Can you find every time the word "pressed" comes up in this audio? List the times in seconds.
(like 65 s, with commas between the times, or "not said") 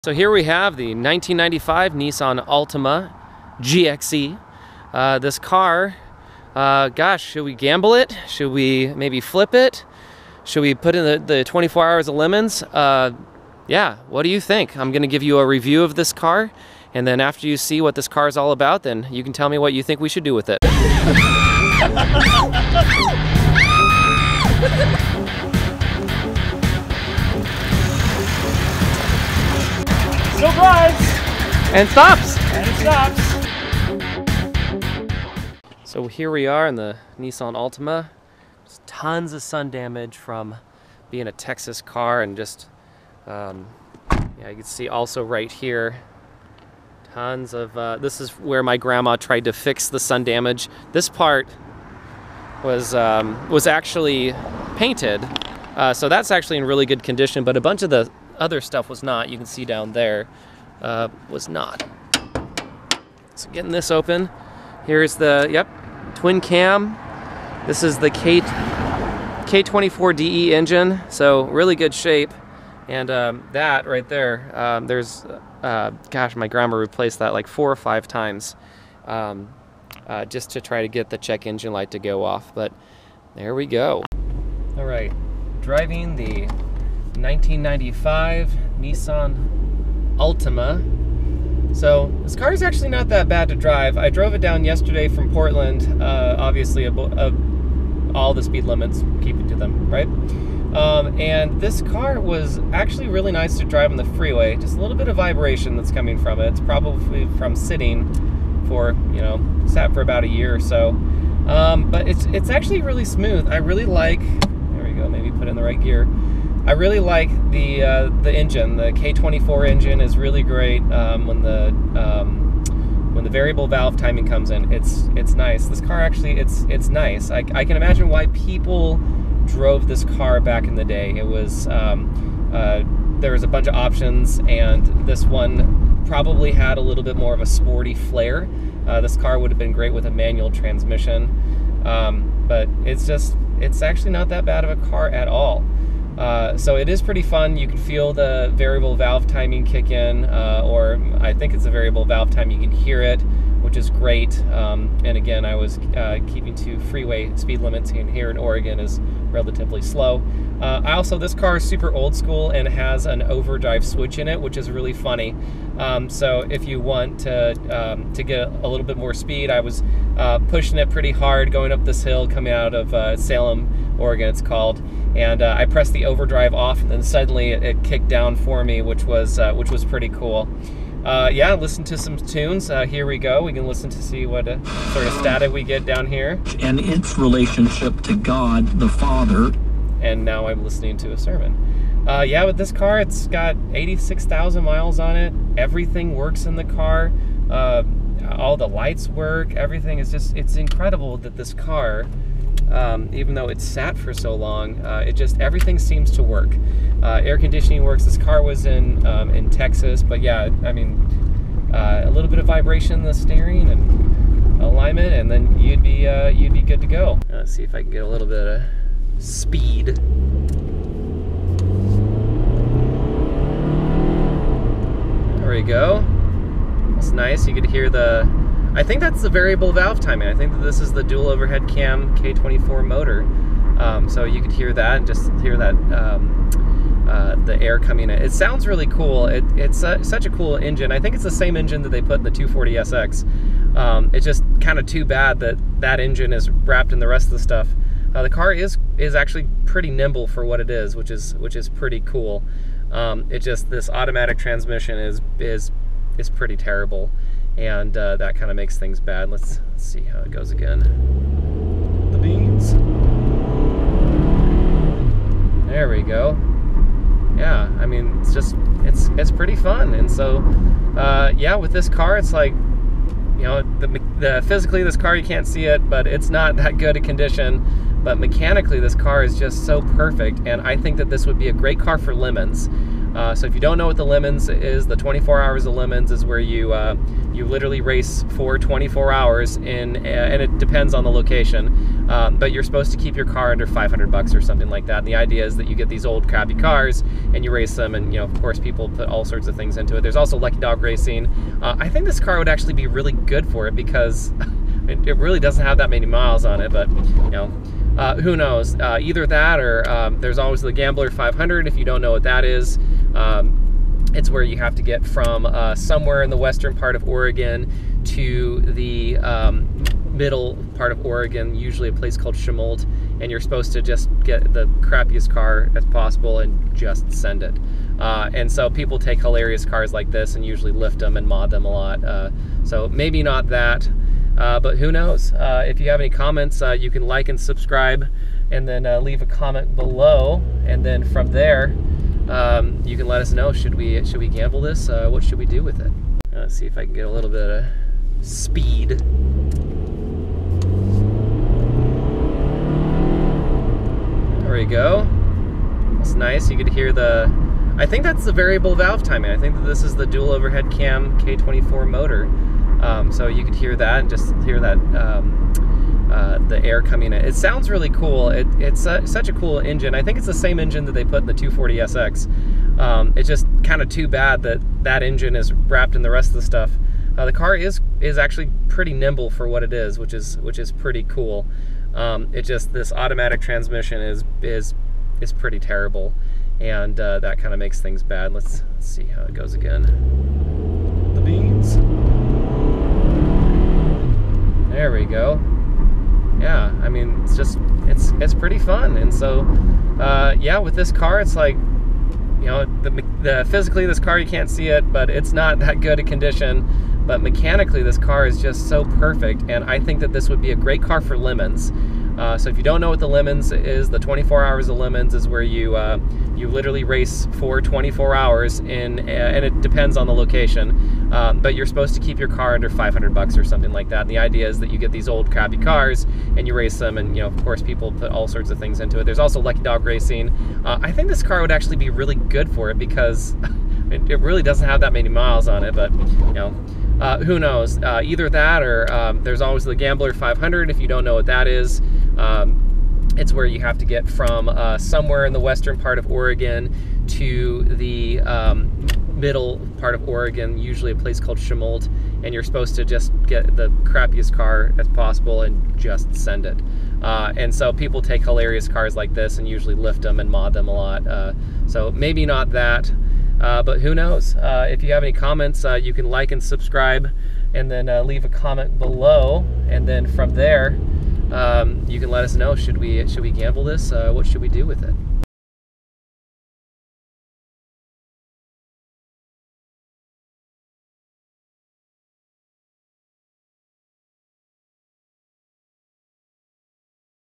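175 s.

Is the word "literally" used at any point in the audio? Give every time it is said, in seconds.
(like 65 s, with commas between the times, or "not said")
287 s, 416 s.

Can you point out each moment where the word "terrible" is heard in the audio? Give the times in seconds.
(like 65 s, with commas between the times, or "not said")
256 s, 385 s.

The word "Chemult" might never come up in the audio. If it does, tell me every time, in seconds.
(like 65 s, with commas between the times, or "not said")
322 s, 451 s.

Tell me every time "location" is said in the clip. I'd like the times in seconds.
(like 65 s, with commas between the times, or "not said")
291 s, 420 s.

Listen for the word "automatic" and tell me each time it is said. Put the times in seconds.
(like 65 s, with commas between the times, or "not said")
253 s, 382 s.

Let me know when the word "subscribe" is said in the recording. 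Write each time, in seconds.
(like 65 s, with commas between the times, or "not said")
337 s, 466 s.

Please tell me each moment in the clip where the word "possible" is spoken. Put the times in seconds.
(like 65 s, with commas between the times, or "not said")
325 s, 454 s.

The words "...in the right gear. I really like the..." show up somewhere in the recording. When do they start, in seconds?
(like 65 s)
115 s.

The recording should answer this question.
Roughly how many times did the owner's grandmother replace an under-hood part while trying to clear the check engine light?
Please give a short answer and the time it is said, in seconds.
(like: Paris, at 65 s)
4 or 5, at 77 s.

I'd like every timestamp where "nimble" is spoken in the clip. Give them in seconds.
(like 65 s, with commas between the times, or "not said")
249 s, 378 s.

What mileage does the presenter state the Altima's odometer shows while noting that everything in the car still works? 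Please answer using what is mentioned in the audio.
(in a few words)
86,000 miles.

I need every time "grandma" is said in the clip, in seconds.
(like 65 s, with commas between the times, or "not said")
48 s, 76 s.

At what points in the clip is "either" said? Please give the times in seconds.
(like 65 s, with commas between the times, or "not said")
309 s, 438 s.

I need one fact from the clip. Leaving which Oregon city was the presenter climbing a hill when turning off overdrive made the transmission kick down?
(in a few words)
Salem.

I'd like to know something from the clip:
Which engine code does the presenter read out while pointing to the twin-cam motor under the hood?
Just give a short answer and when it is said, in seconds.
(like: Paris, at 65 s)
K24DE, at 68 s.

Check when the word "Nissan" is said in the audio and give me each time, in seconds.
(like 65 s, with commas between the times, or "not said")
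1 s, 37 s, 88 s.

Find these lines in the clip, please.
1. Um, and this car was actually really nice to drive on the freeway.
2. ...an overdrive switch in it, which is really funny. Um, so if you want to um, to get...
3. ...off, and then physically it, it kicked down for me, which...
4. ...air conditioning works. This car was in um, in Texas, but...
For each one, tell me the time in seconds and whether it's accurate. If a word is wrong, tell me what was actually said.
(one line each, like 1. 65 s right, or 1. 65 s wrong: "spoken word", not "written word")
1. 100 s right
2. 163 s right
3. 176 s wrong: "suddenly", not "physically"
4. 207 s right.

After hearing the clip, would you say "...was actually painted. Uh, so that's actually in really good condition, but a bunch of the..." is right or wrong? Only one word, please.
right.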